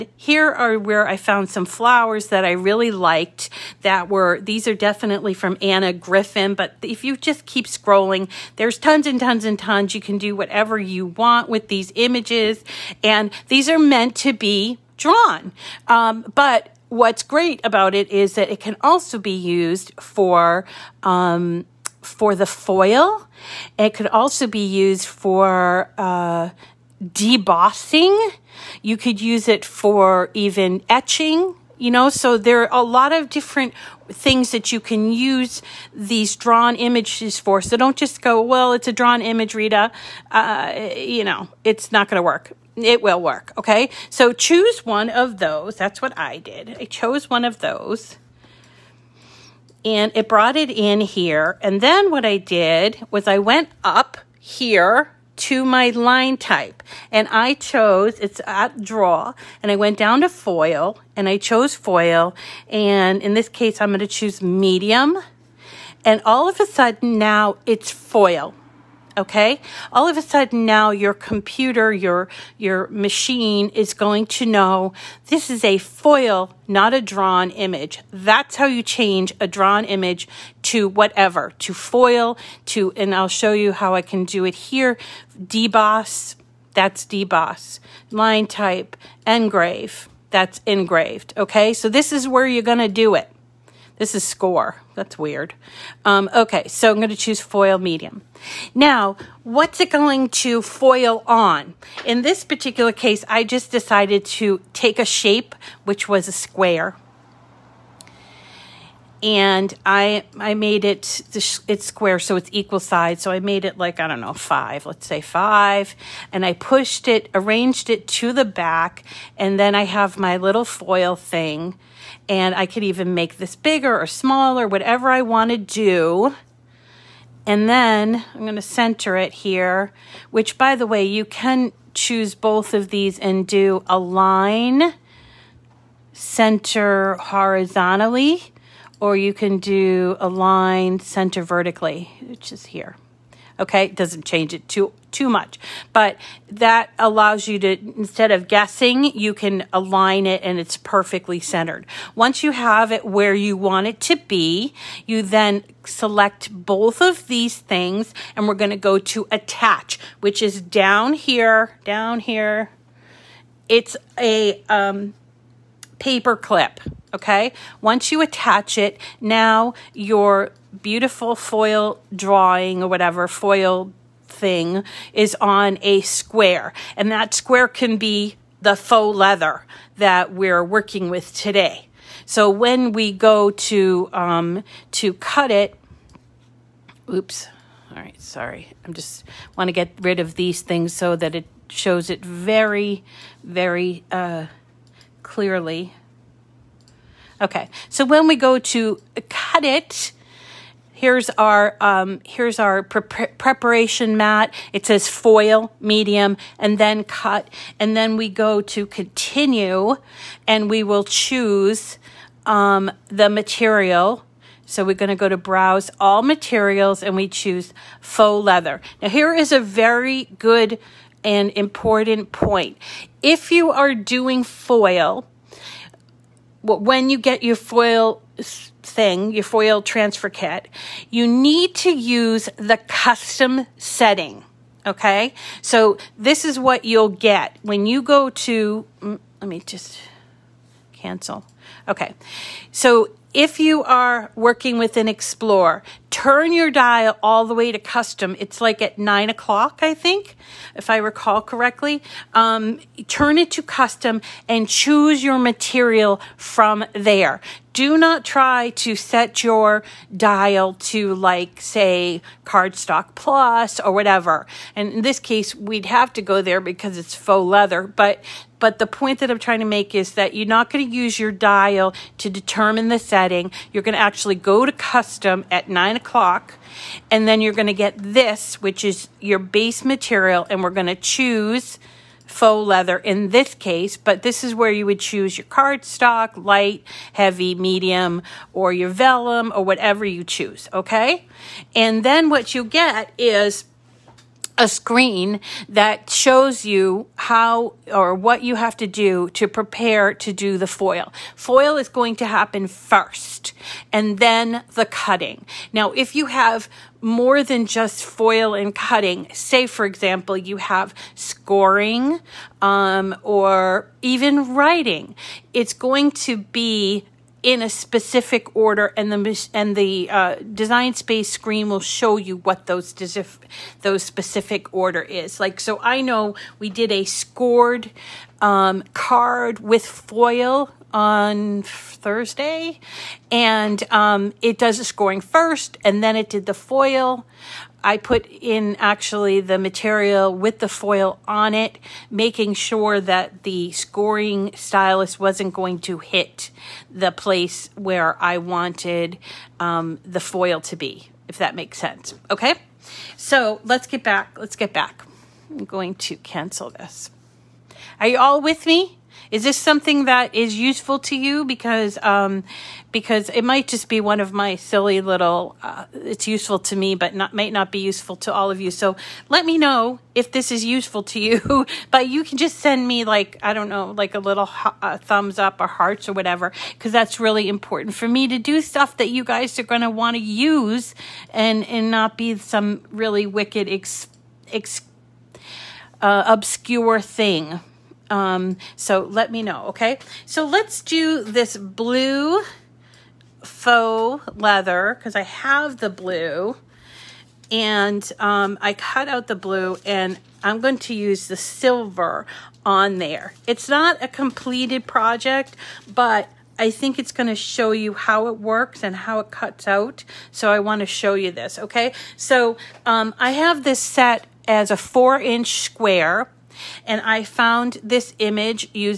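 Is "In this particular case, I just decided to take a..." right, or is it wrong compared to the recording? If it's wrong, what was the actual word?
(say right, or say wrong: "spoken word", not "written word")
right.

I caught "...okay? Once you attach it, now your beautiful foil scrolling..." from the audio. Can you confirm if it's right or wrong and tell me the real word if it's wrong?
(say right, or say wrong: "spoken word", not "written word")
wrong: "drawing", not "scrolling".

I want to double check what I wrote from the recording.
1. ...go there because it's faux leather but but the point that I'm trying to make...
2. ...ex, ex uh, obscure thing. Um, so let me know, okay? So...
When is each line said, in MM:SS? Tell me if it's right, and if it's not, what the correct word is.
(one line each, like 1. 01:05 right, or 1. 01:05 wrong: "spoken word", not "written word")
1. 04:26 right
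2. 06:23 right.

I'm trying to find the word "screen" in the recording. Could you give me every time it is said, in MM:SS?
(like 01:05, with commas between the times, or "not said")
04:54, 05:21.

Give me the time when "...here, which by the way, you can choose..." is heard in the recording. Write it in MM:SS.
02:09.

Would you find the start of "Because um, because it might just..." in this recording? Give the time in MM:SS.
06:01.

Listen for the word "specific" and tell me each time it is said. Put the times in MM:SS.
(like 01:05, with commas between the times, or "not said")
05:17, 05:24.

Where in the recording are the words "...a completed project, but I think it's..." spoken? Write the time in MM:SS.
06:44.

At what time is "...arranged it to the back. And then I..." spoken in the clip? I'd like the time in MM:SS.
01:57.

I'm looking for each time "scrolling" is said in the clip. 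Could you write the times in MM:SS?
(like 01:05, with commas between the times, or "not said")
00:07.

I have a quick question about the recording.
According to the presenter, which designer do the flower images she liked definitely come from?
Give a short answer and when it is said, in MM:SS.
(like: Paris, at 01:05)
Anna Griffin, at 00:05.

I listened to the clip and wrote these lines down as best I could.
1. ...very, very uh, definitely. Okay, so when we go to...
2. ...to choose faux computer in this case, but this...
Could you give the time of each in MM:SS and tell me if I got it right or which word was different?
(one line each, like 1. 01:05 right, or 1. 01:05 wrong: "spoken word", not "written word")
1. 03:12 wrong: "clearly", not "definitely"
2. 04:40 wrong: "leather", not "computer".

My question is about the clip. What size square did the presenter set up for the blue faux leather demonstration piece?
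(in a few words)
4 inch.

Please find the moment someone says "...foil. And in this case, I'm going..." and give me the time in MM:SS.
01:01.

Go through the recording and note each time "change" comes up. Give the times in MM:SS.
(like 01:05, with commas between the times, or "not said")
01:18, 02:24.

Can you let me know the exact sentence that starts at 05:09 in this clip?
Say, for example, you have scoring um, or even writing.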